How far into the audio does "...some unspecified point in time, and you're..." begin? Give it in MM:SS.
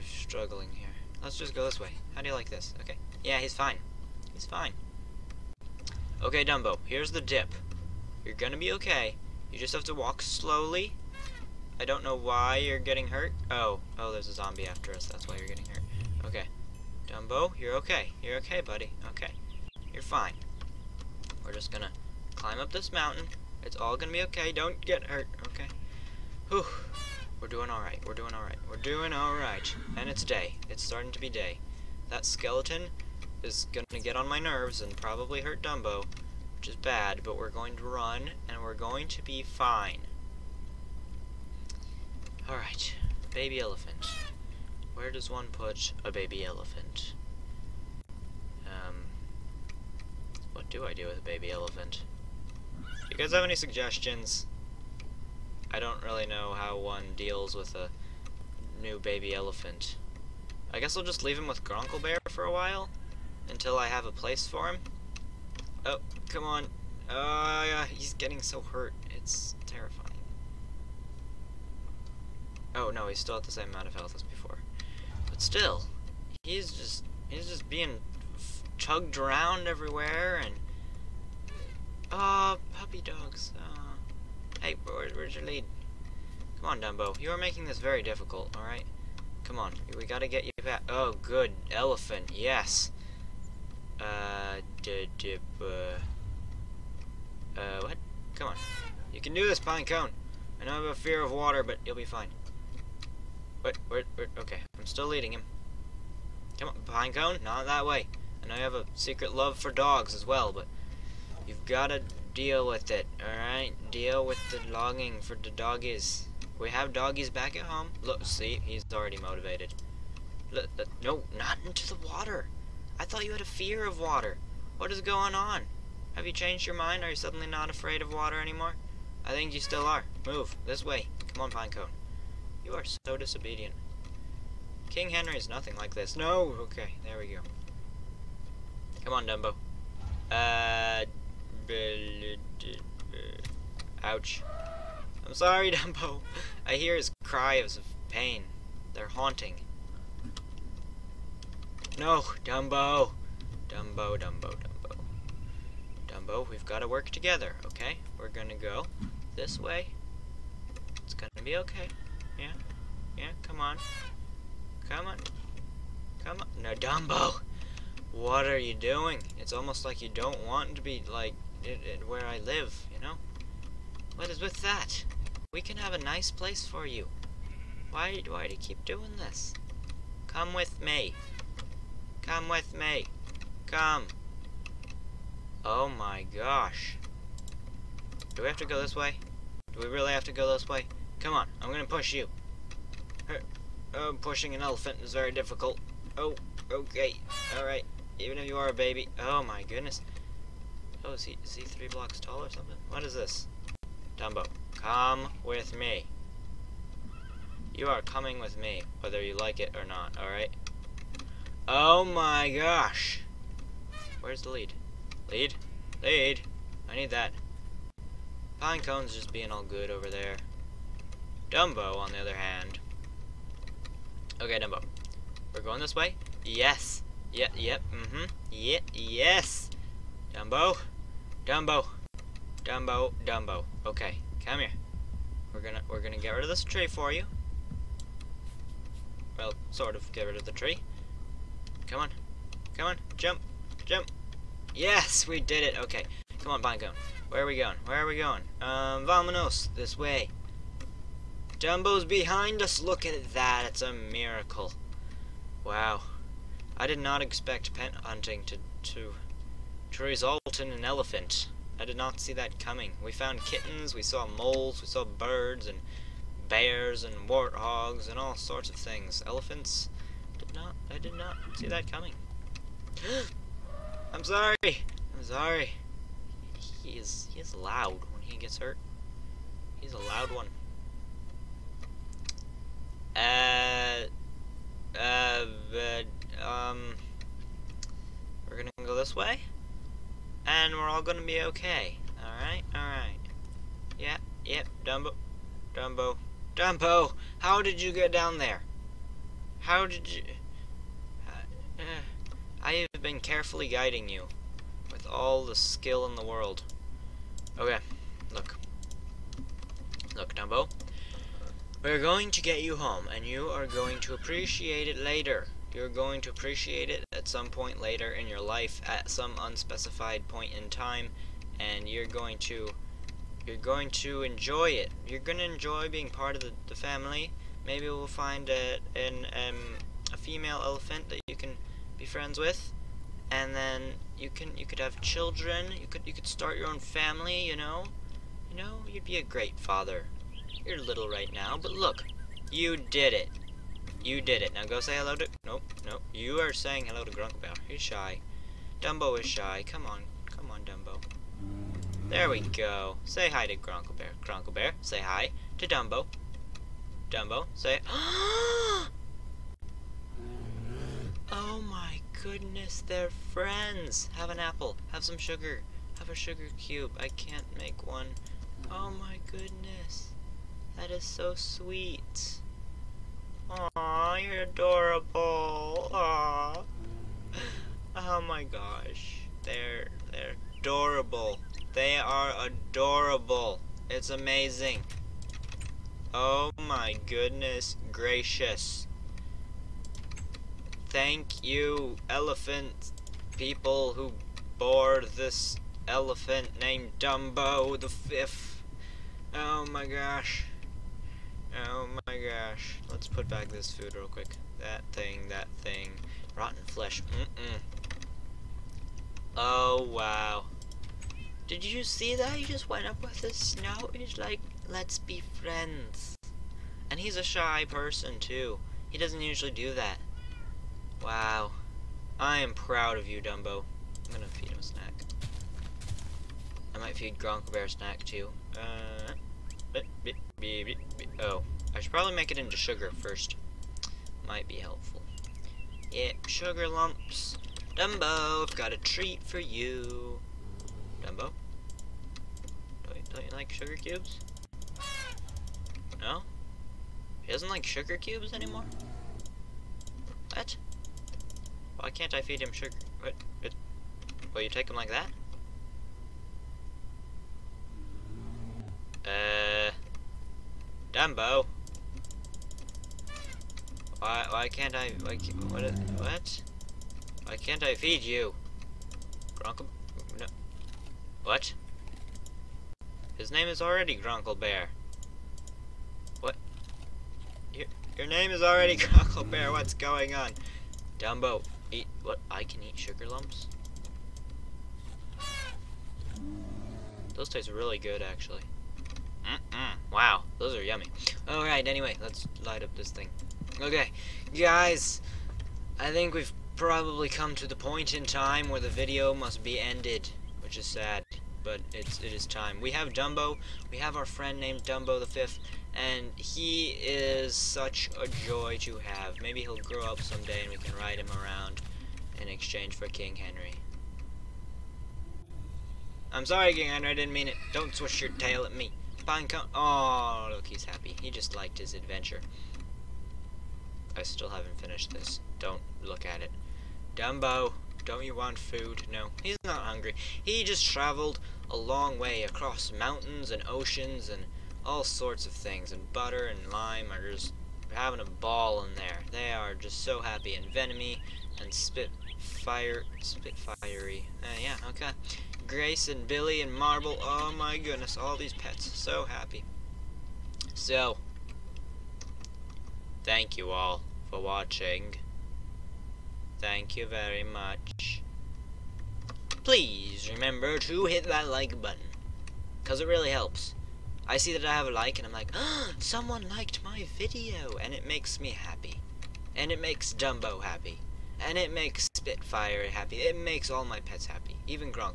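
05:19.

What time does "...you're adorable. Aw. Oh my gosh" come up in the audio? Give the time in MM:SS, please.
06:14.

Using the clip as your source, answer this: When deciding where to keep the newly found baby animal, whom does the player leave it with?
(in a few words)
Gronkle Bear.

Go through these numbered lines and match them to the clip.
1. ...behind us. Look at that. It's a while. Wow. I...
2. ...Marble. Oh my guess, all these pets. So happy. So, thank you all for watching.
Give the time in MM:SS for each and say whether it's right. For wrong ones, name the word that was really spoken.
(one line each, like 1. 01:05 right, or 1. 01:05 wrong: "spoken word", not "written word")
1. 04:12 wrong: "miracle", not "while"
2. 09:06 wrong: "goodness", not "guess".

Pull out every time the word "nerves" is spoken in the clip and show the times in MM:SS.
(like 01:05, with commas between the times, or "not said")
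00:34.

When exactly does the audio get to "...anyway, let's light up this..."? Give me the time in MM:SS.
08:11.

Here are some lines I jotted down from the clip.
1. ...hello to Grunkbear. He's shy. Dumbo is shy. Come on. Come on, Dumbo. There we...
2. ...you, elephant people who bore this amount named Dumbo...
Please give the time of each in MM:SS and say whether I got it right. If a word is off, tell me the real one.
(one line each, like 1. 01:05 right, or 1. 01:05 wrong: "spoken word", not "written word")
1. 05:46 right
2. 06:31 wrong: "elephant", not "amount".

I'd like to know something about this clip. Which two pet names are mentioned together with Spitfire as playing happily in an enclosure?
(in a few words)
Butter and Lime.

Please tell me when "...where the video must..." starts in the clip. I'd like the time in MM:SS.
08:18.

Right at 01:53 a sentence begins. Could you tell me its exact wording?
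Deal with the longing for the doggies.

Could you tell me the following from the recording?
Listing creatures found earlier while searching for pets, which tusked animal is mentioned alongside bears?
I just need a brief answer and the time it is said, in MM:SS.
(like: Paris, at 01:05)
warthogs, at 04:27.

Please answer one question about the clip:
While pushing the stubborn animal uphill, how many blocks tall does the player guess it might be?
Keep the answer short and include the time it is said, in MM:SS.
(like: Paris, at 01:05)
3, at 03:21.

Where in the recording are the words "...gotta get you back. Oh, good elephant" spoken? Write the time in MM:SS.
01:30.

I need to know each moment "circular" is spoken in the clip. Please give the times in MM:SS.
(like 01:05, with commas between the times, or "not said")
not said.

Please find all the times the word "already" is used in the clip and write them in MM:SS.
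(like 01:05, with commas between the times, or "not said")
01:58, 07:53, 07:58.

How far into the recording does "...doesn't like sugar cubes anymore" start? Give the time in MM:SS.
07:27.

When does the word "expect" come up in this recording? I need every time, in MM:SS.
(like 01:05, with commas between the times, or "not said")
04:17.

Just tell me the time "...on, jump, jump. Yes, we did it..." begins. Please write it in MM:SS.
04:02.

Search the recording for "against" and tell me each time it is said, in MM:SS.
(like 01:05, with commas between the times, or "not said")
not said.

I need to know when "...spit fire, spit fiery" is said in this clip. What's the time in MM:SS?
09:01.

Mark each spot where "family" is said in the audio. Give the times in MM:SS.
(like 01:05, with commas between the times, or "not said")
05:26, 05:36.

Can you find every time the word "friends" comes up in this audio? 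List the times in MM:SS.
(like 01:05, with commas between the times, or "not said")
05:32, 06:03, 06:55, 08:24.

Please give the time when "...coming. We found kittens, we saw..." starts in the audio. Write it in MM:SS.
04:22.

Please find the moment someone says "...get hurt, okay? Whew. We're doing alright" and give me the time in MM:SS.
00:24.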